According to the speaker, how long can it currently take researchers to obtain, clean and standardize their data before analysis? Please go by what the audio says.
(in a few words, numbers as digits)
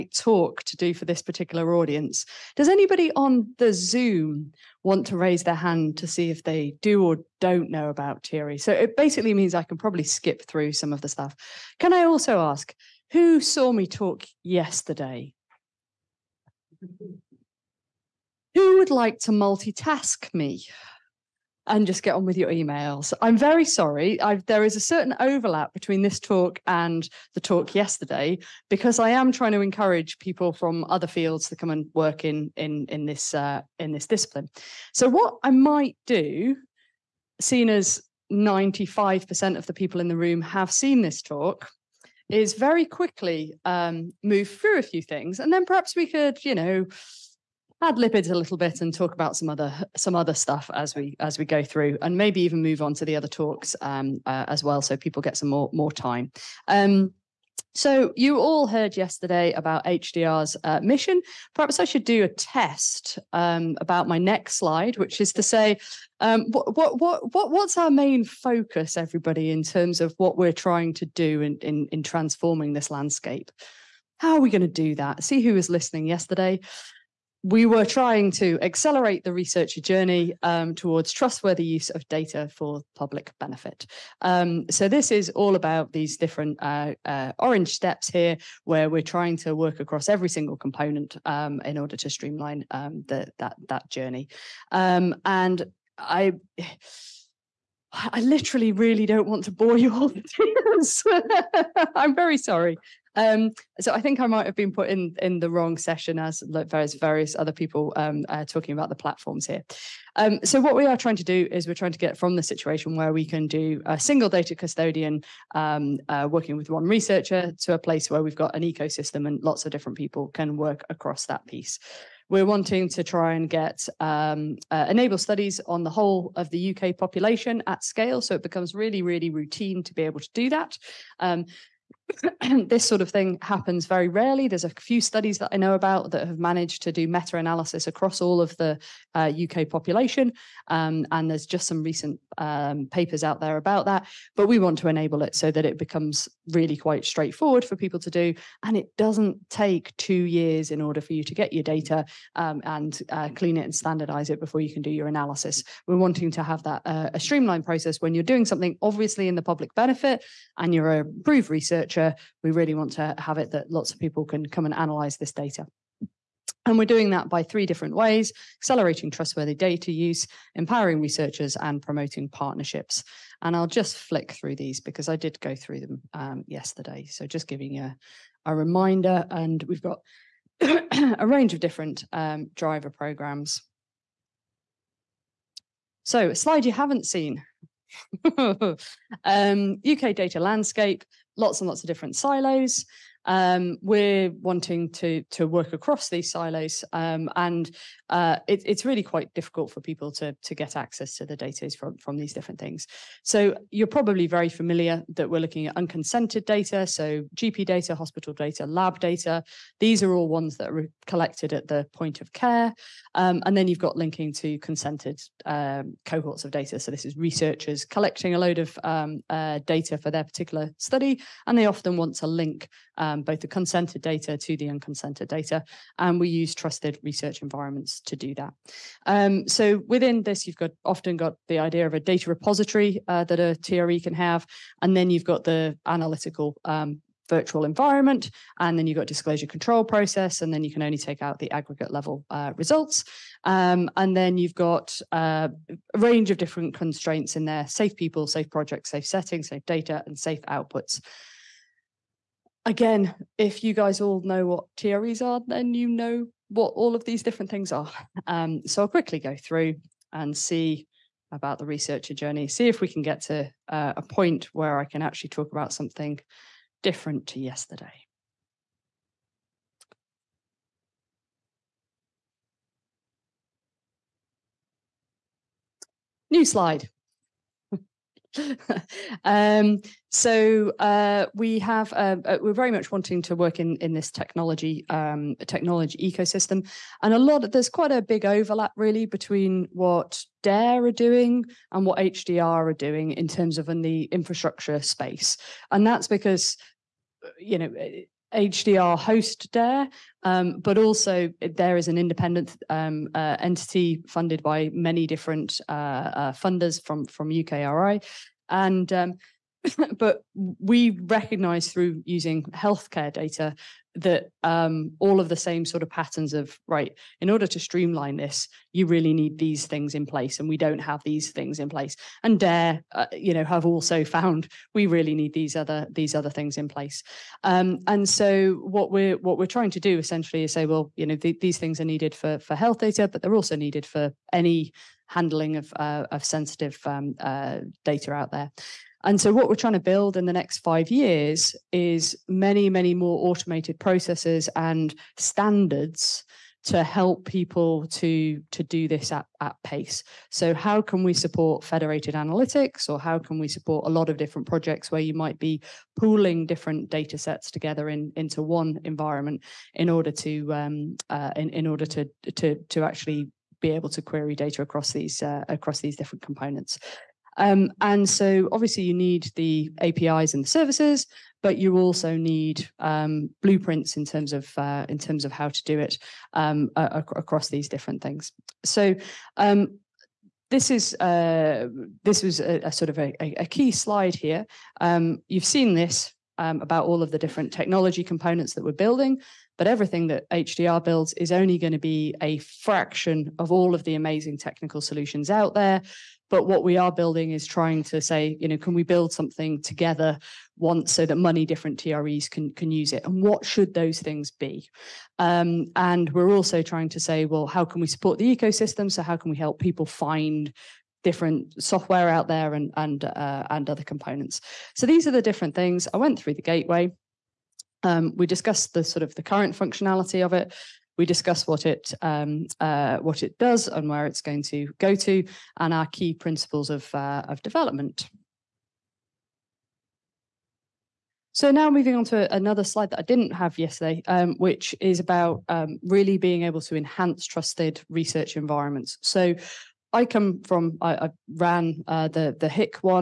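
2 years.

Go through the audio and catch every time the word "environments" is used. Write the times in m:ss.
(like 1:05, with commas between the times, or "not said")
3:47, 3:57, 5:58, 7:18.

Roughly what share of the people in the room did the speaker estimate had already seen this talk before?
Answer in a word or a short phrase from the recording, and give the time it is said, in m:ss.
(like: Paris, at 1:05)
95%, at 0:38.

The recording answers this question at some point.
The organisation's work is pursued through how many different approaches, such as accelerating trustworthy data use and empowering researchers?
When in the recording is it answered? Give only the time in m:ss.
2:47.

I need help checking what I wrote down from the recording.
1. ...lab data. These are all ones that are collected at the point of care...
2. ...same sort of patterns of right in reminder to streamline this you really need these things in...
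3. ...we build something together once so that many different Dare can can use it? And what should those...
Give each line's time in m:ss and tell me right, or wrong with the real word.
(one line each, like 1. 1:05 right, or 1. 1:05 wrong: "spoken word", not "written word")
1. 3:28 right
2. 5:15 wrong: "order", not "reminder"
3. 6:38 wrong: "TREs", not "Dare".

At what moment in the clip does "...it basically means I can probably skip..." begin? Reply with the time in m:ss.
0:08.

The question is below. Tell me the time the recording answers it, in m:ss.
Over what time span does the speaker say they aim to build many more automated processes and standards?
5:40.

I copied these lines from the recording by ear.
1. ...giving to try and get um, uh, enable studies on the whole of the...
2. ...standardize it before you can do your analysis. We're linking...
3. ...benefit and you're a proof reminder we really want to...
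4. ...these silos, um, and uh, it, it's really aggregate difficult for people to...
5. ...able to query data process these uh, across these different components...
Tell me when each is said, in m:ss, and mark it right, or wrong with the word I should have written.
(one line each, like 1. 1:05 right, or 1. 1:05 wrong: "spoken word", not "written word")
1. 2:02 wrong: "wanting", not "giving"
2. 2:33 wrong: "wanting", not "linking"
3. 2:39 wrong: "researcher", not "reminder"
4. 3:16 wrong: "quite", not "aggregate"
5. 6:03 wrong: "across", not "process".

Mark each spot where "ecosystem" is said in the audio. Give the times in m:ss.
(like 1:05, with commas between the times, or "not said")
1:58, 4:45, 6:48.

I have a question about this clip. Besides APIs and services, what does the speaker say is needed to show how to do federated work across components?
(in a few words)
Blueprints.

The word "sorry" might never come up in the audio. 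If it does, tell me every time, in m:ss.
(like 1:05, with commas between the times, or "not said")
0:23, 1:42.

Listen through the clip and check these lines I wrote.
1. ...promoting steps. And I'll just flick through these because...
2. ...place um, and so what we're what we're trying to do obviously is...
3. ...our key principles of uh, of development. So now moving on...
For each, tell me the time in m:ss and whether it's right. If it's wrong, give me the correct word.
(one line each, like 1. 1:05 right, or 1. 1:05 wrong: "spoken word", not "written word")
1. 2:51 wrong: "partnerships", not "steps"
2. 5:26 wrong: "essentially", not "obviously"
3. 7:05 right.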